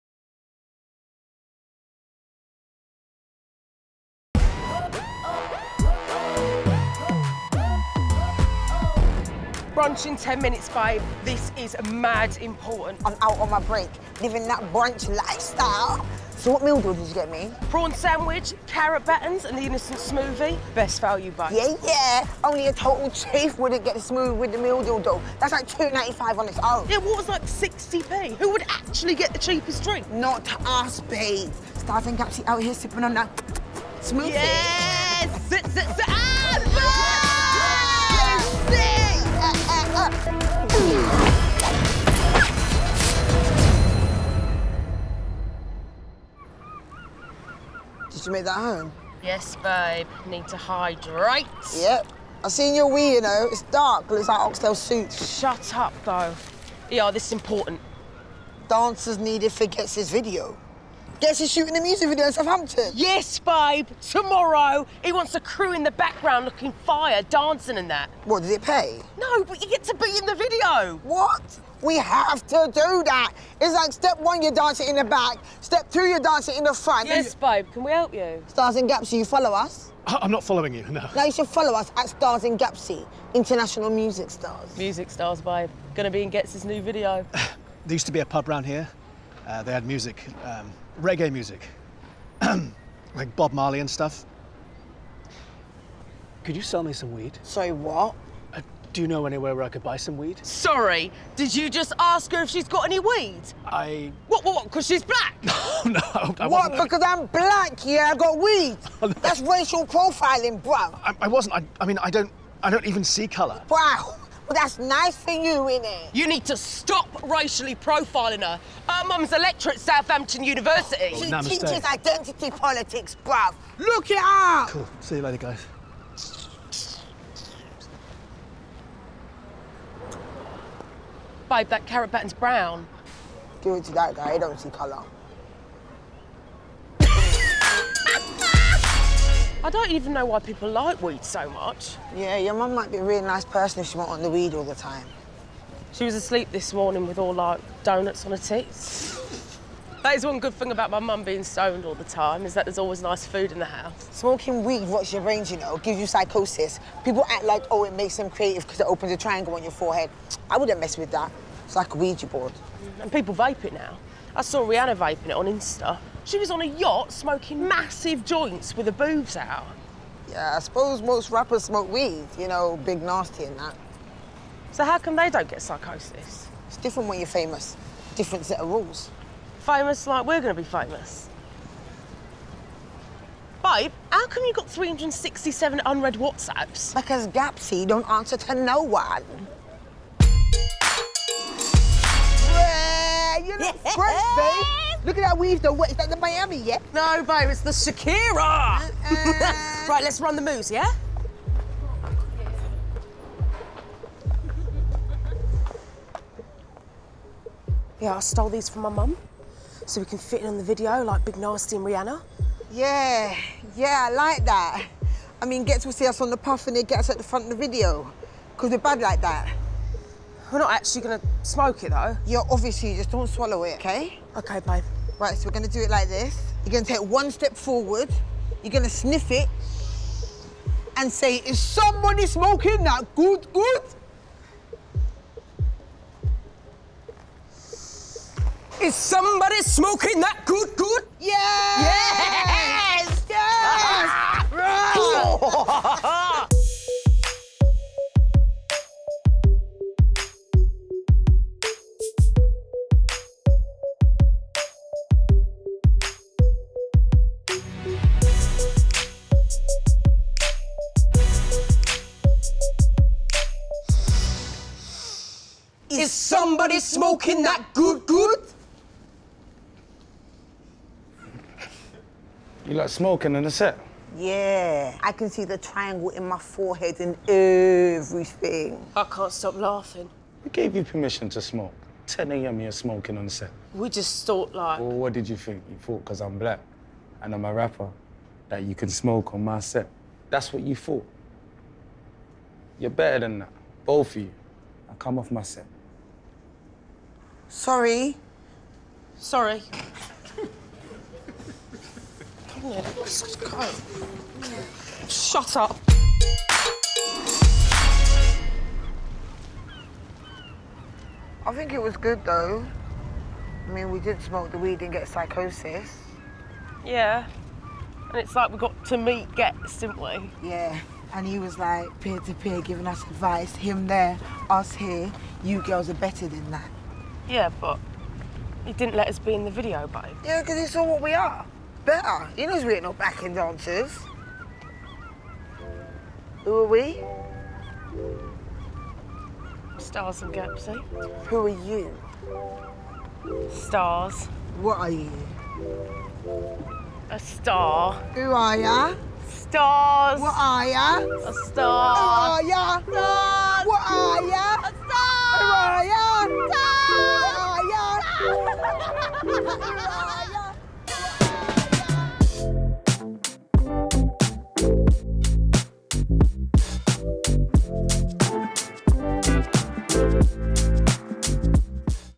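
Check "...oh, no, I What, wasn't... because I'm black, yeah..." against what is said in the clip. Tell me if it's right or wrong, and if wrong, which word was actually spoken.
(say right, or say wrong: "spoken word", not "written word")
right.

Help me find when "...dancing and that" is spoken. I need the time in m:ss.
1:07.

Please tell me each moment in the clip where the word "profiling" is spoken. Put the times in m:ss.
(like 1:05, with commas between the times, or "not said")
1:49, 1:57.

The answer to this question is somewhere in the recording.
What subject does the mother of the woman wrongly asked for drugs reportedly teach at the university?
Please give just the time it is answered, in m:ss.
2:01.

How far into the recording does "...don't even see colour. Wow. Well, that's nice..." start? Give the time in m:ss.
1:52.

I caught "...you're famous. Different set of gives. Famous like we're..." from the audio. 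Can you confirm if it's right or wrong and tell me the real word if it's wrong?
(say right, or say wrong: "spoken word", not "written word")
wrong: "rules", not "gives".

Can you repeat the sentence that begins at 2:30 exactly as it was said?
that is one good thing about my mum being stoned all the time, is that there's always nice food in the house.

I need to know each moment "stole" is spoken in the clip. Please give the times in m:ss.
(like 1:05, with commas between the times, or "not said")
3:28.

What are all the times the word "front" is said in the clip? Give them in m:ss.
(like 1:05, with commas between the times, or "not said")
1:16, 3:37.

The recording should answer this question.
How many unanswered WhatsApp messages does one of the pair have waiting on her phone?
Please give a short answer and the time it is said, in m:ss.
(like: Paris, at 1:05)
367, at 3:04.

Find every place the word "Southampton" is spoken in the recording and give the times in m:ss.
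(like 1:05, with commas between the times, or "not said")
1:02, 1:59.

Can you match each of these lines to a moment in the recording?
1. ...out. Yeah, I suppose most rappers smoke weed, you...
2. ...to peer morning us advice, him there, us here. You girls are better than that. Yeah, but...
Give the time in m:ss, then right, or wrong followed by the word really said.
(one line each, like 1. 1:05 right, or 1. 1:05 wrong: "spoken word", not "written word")
1. 2:49 right
2. 5:22 wrong: "giving", not "morning".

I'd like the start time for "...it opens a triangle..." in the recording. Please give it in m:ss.
2:38.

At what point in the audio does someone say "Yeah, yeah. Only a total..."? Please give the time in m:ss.
0:21.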